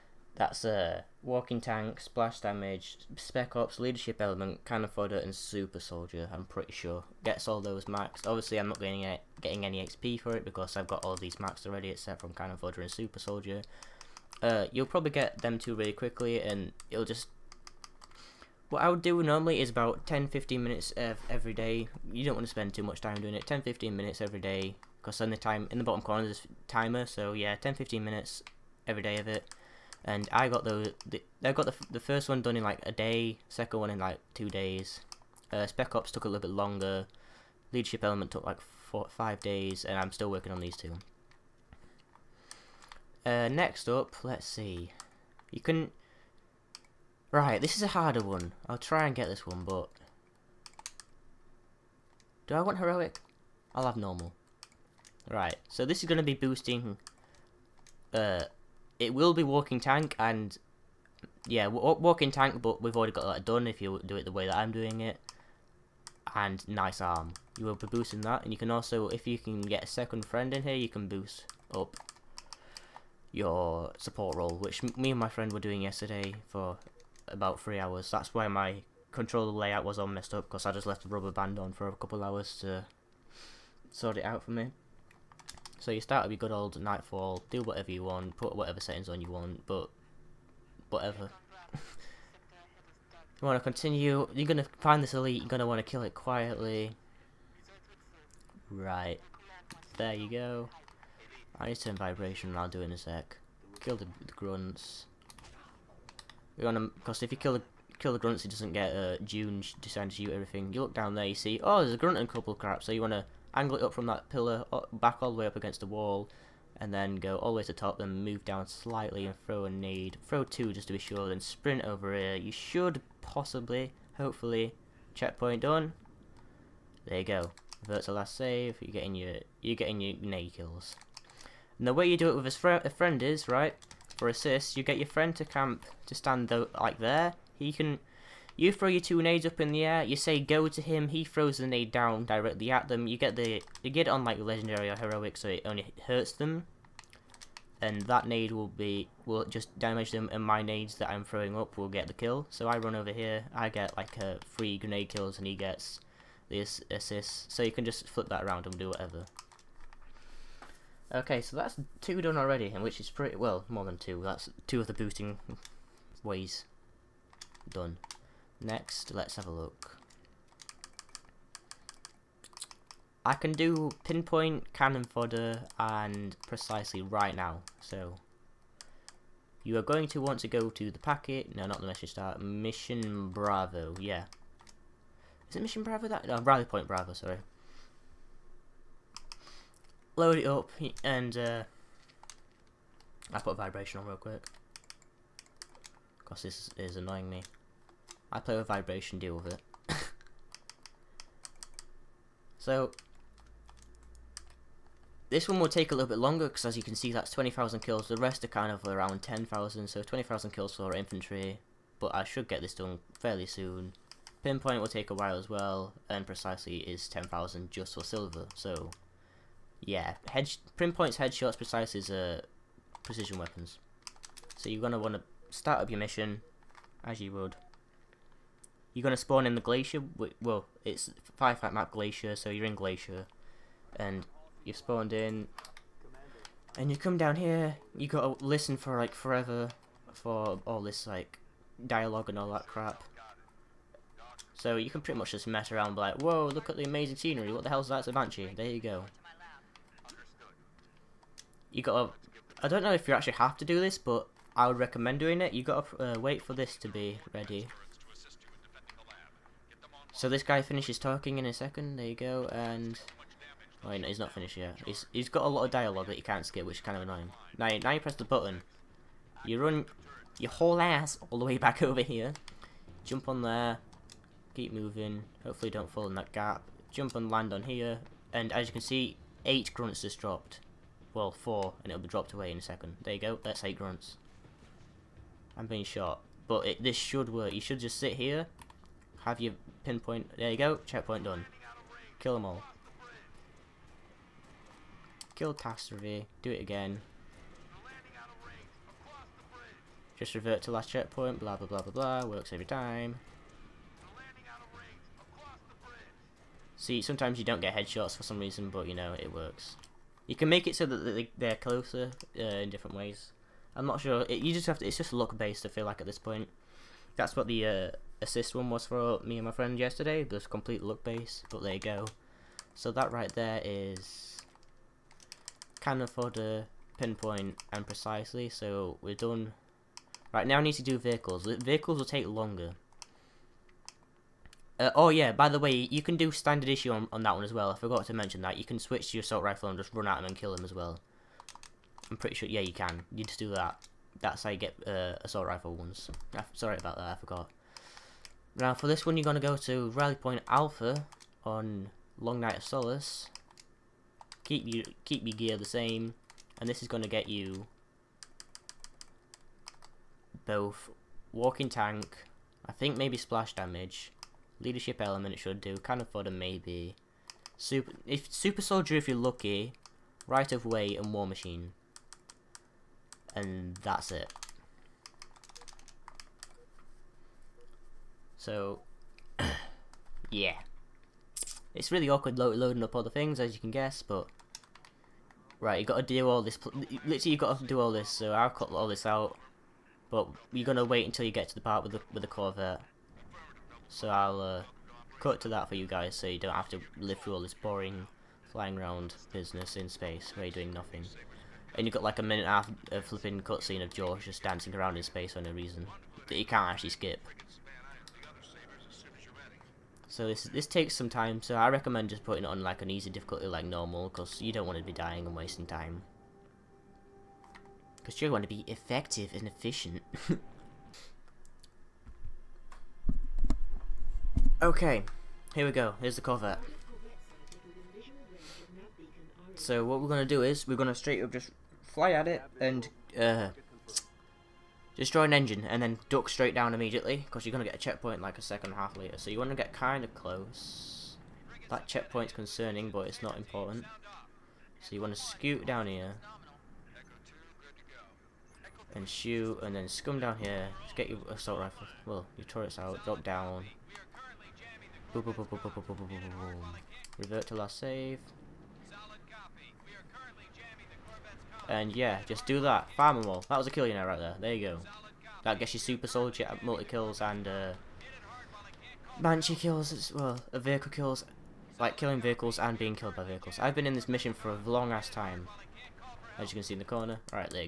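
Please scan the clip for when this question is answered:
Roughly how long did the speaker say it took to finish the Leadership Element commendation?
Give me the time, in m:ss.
0:38.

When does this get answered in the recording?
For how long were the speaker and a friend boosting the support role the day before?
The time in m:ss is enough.
1:17.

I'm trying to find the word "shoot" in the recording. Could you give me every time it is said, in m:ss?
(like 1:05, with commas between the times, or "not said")
1:50, 7:29.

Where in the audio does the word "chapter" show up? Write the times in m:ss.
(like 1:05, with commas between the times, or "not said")
not said.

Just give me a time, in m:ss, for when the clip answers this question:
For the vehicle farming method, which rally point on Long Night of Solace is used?
5:49.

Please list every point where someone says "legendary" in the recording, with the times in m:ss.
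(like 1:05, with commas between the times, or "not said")
2:24.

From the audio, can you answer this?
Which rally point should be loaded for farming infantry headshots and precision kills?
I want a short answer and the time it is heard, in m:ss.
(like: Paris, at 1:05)
Rally Point Bravo, at 3:06.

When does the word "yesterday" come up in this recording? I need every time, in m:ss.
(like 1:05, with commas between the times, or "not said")
1:15, 5:19.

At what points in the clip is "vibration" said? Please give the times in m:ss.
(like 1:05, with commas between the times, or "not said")
1:41, 3:13, 3:18.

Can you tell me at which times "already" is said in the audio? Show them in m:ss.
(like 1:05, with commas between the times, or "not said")
0:11, 1:02, 2:42.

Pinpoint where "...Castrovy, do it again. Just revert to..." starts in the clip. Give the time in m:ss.
4:55.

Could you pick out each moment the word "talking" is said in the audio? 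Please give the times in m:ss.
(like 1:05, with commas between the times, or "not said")
4:20.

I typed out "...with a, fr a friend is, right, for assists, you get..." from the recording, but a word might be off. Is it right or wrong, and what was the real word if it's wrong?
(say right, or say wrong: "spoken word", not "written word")
right.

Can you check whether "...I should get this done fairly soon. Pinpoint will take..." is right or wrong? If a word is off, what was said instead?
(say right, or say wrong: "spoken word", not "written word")
right.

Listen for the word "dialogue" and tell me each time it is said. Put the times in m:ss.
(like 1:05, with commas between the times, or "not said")
4:01, 4:25.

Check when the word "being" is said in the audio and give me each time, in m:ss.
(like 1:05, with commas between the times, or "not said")
4:45, 7:52.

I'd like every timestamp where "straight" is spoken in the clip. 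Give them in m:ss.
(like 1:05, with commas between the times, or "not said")
7:10, 7:16.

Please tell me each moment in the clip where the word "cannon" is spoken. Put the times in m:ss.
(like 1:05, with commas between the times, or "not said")
0:04, 0:12, 2:54, 5:25.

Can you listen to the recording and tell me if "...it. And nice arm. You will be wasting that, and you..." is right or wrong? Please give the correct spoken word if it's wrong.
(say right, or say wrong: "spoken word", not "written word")
wrong: "boosting", not "wasting".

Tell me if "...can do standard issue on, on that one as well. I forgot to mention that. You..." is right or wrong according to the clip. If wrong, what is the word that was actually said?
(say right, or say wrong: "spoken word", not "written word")
right.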